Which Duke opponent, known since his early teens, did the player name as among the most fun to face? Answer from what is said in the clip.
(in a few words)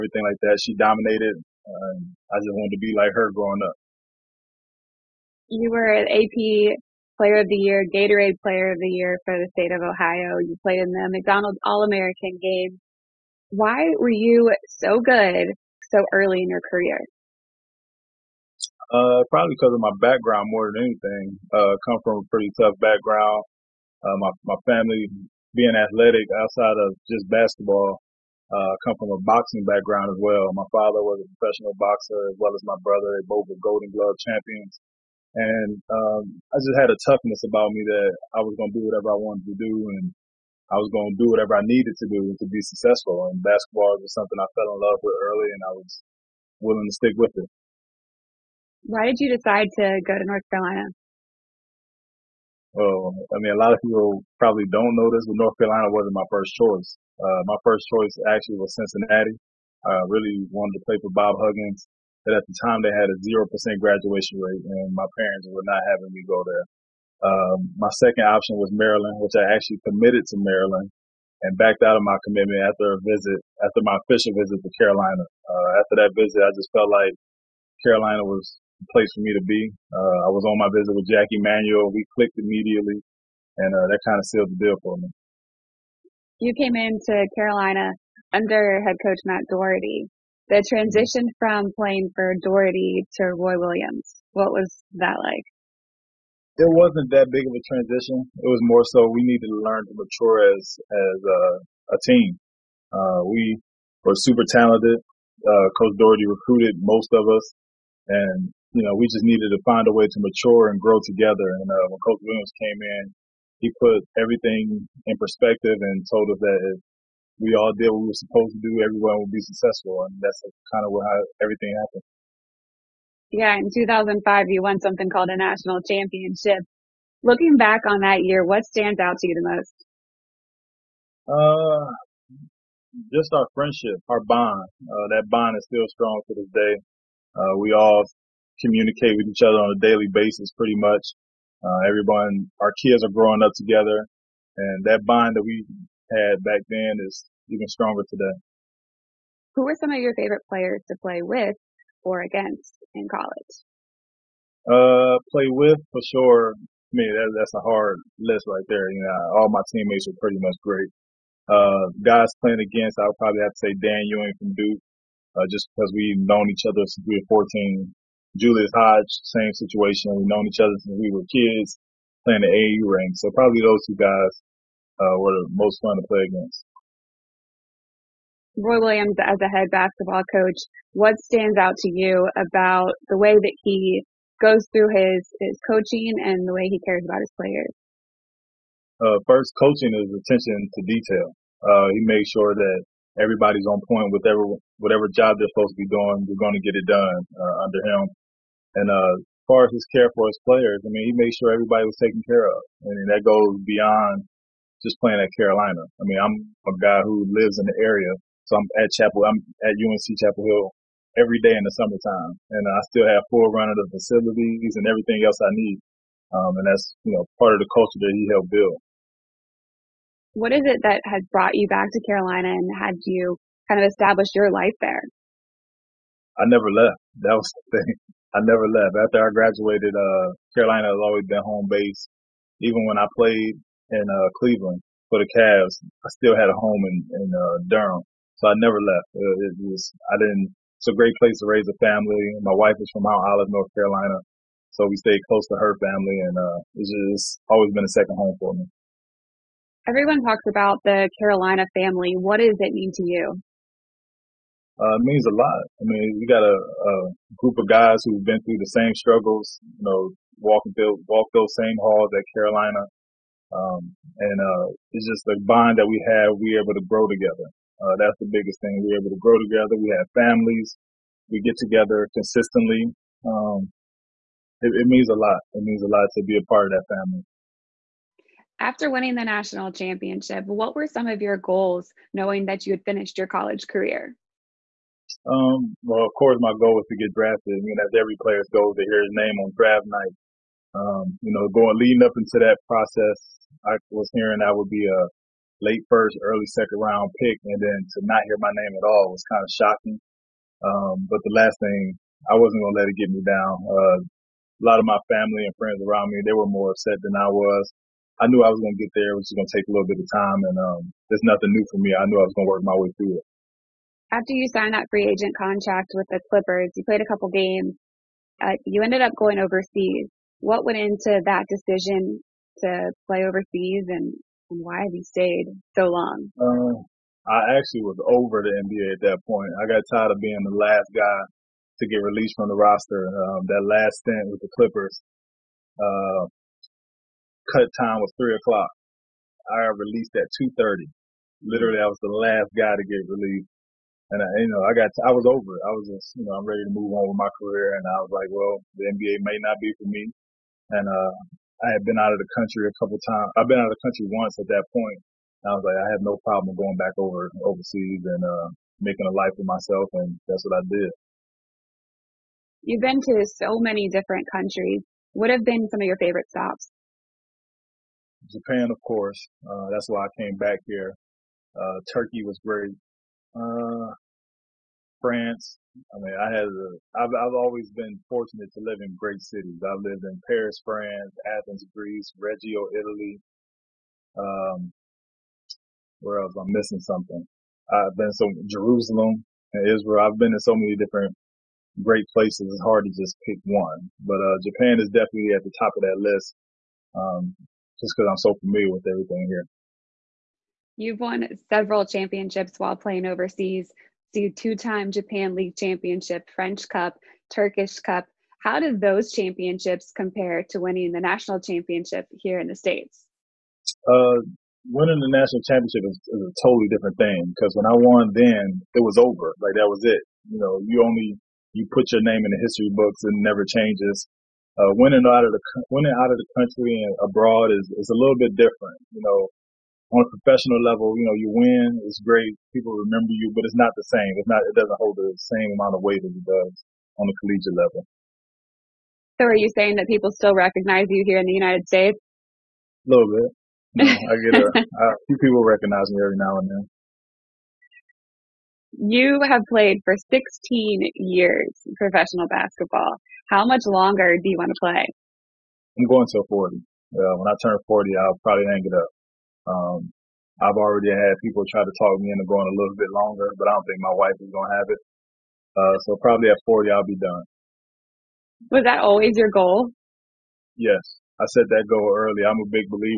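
Dan Ewing.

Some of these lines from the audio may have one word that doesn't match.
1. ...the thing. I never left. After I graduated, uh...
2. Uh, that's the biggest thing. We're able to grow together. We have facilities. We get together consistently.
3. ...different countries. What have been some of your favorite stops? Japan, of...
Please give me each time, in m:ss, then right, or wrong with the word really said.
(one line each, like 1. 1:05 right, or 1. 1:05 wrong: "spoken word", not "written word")
1. 3:47 right
2. 4:27 wrong: "families", not "facilities"
3. 6:03 right.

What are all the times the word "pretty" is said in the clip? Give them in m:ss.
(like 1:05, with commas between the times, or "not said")
0:22, 2:20, 2:40.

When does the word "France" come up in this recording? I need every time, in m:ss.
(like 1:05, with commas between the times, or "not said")
6:15, 6:20.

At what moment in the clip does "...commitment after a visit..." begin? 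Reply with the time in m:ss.
1:12.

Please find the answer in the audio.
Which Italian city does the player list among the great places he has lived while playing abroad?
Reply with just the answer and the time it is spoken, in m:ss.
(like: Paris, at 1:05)
Reggio, at 6:22.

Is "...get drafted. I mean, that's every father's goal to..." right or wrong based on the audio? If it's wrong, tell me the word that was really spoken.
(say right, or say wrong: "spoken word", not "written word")
wrong: "player", not "father".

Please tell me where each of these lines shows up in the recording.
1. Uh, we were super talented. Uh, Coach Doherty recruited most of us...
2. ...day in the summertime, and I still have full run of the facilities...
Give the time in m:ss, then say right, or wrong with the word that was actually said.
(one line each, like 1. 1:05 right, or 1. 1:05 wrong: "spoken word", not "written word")
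1. 1:42 right
2. 3:31 right.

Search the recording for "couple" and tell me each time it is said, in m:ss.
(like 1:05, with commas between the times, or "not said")
5:17, 5:52.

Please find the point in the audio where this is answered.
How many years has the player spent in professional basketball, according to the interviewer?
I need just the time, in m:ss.
7:30.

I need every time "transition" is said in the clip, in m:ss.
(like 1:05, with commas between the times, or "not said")
1:30, 1:37.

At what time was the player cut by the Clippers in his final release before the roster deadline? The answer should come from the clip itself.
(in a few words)
2:30.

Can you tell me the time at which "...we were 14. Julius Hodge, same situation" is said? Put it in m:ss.
2:47.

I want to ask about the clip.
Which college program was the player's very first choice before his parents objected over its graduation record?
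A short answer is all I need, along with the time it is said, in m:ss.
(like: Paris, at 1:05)
Cincinnati, at 0:58.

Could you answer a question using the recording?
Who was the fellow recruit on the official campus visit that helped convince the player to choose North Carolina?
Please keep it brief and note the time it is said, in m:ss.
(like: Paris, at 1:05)
Jackie Manuel, at 1:21.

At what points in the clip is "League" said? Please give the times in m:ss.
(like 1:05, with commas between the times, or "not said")
6:45.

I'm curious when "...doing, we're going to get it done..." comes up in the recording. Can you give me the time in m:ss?
3:15.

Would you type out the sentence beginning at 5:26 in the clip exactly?
Um, I actually was over the NBA at that point.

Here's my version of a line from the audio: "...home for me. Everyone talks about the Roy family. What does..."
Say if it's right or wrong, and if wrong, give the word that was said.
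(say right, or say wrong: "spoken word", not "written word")
wrong: "Carolina", not "Roy".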